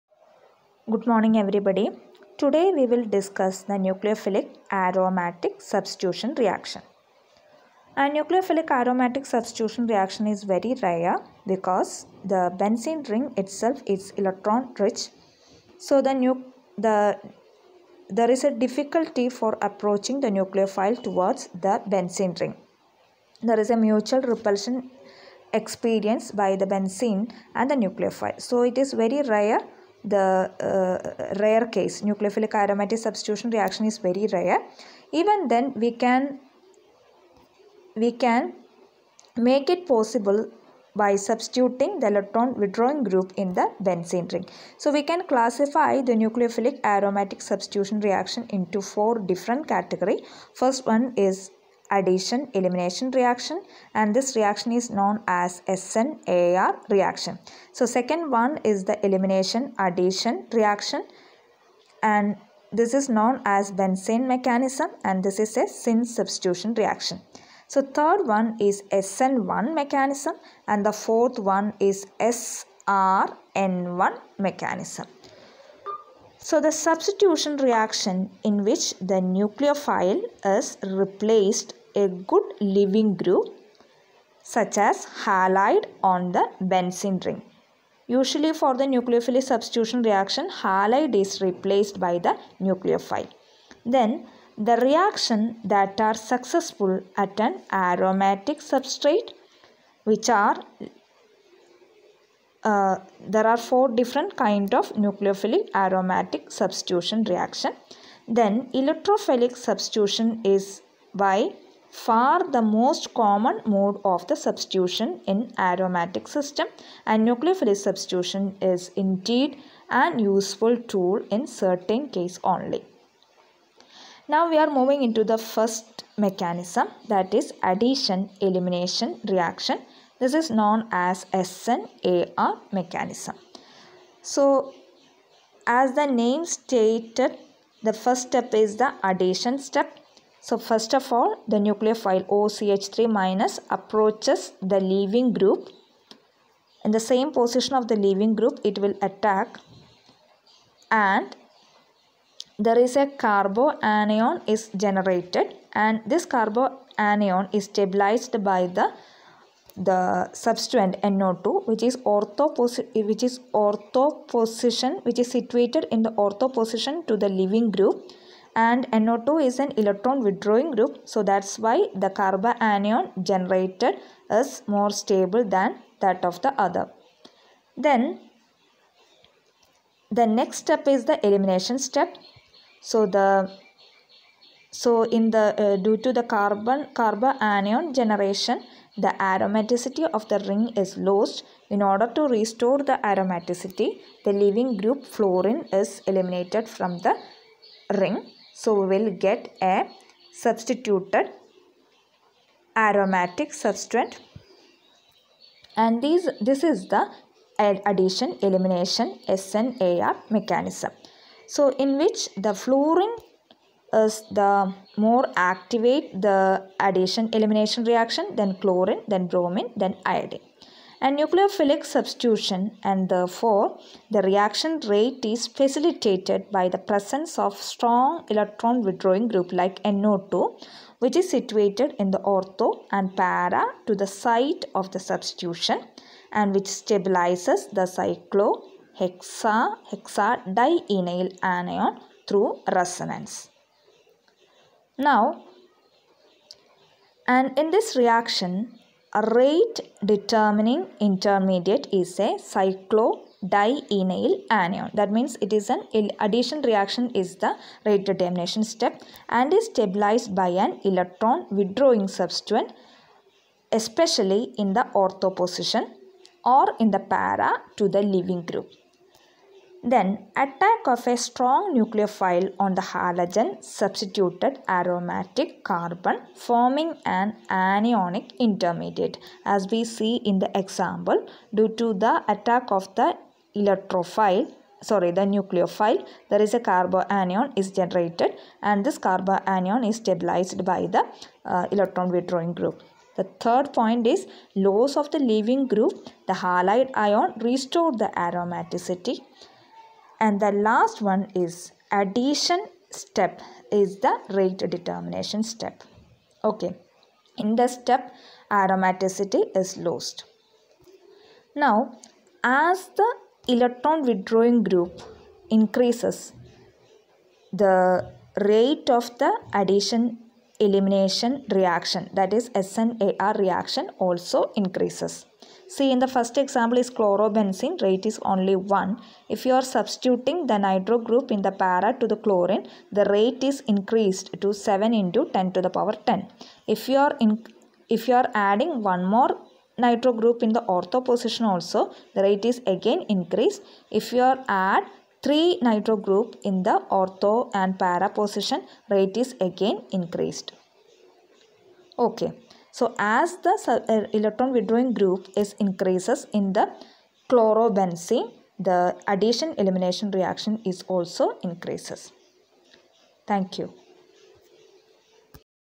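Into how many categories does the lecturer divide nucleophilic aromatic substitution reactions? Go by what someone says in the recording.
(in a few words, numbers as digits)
4.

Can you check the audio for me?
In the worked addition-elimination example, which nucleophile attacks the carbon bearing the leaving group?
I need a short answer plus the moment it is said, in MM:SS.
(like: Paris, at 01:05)
OCH3 minus, at 02:22.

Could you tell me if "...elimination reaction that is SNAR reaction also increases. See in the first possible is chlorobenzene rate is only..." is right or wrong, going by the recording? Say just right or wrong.
wrong.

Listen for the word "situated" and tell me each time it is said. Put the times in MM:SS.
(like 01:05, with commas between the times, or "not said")
02:45, 03:51.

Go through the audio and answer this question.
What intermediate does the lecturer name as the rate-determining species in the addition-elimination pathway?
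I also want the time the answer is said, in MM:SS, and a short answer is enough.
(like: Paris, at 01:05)
cyclodienyl anion, at 04:12.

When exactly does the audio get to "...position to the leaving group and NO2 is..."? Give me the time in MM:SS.
02:46.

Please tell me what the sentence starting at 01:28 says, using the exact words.
Usually for the nucleophilic substitution reaction, halide is replaced by the nucleophile.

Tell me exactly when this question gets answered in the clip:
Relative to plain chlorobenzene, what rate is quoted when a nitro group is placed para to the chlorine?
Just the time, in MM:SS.
05:34.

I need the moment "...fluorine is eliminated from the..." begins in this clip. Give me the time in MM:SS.
03:15.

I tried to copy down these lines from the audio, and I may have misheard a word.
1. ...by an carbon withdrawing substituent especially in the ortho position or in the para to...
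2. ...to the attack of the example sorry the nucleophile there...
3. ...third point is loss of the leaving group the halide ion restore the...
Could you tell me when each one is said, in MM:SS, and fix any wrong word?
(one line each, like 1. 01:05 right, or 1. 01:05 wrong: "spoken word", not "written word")
1. 04:20 wrong: "electron", not "carbon"
2. 04:41 wrong: "electrophile", not "example"
3. 04:53 right.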